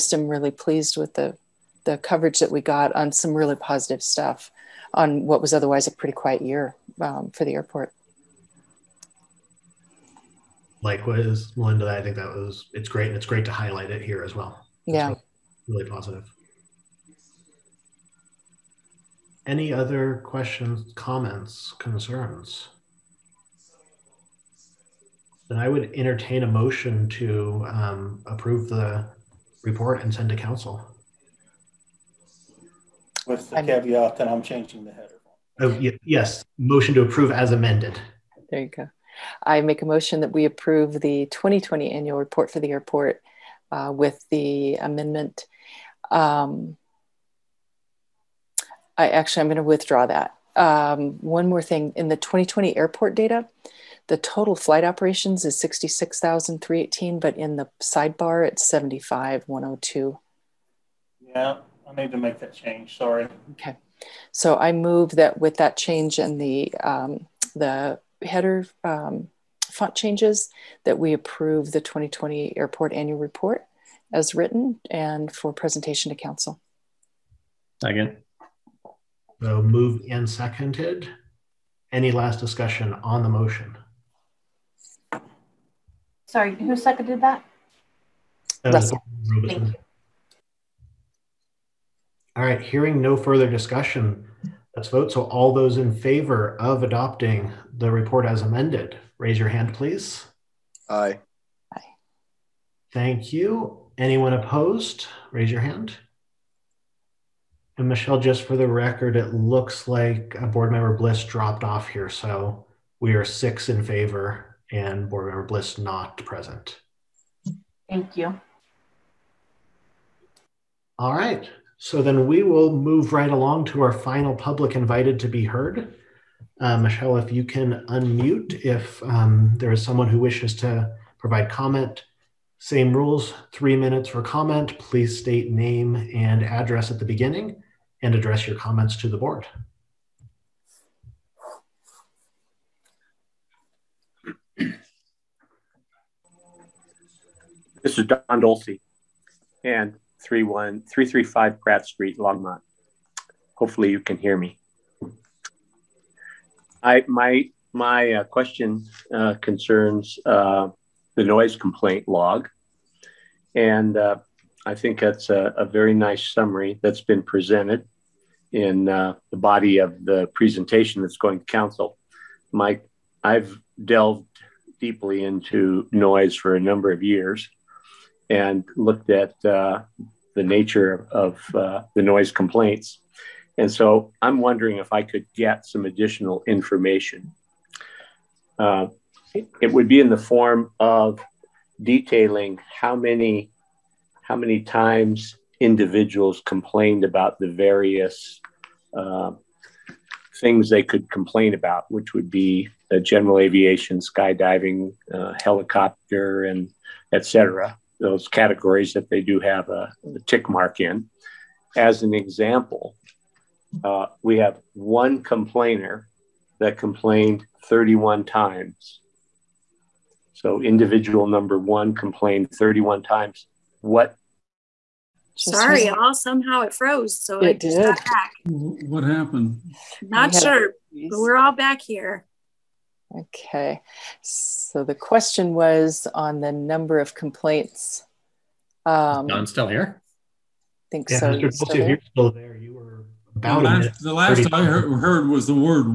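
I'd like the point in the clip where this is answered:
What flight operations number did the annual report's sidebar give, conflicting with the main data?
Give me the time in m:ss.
0:58.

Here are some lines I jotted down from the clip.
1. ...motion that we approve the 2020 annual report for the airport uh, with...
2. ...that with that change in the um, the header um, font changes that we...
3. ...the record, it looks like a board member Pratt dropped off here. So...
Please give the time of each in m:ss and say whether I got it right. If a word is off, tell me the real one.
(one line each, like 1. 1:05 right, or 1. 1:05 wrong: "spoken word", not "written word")
1. 0:39 right
2. 1:05 right
3. 1:48 wrong: "Bliss", not "Pratt".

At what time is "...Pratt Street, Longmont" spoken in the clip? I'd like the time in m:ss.
2:31.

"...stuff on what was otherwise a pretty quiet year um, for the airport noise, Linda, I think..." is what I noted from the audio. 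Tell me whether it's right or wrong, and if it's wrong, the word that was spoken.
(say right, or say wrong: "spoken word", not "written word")
wrong: "likewise", not "noise".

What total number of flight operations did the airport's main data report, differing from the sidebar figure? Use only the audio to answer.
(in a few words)
66,318.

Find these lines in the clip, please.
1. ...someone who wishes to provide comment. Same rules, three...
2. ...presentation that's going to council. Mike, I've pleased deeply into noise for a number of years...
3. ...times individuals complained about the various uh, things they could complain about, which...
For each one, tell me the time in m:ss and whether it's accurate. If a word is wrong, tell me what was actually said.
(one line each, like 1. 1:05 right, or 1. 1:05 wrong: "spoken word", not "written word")
1. 2:09 right
2. 2:50 wrong: "delved", not "pleased"
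3. 3:14 right.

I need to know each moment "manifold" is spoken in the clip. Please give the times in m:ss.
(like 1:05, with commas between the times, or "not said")
not said.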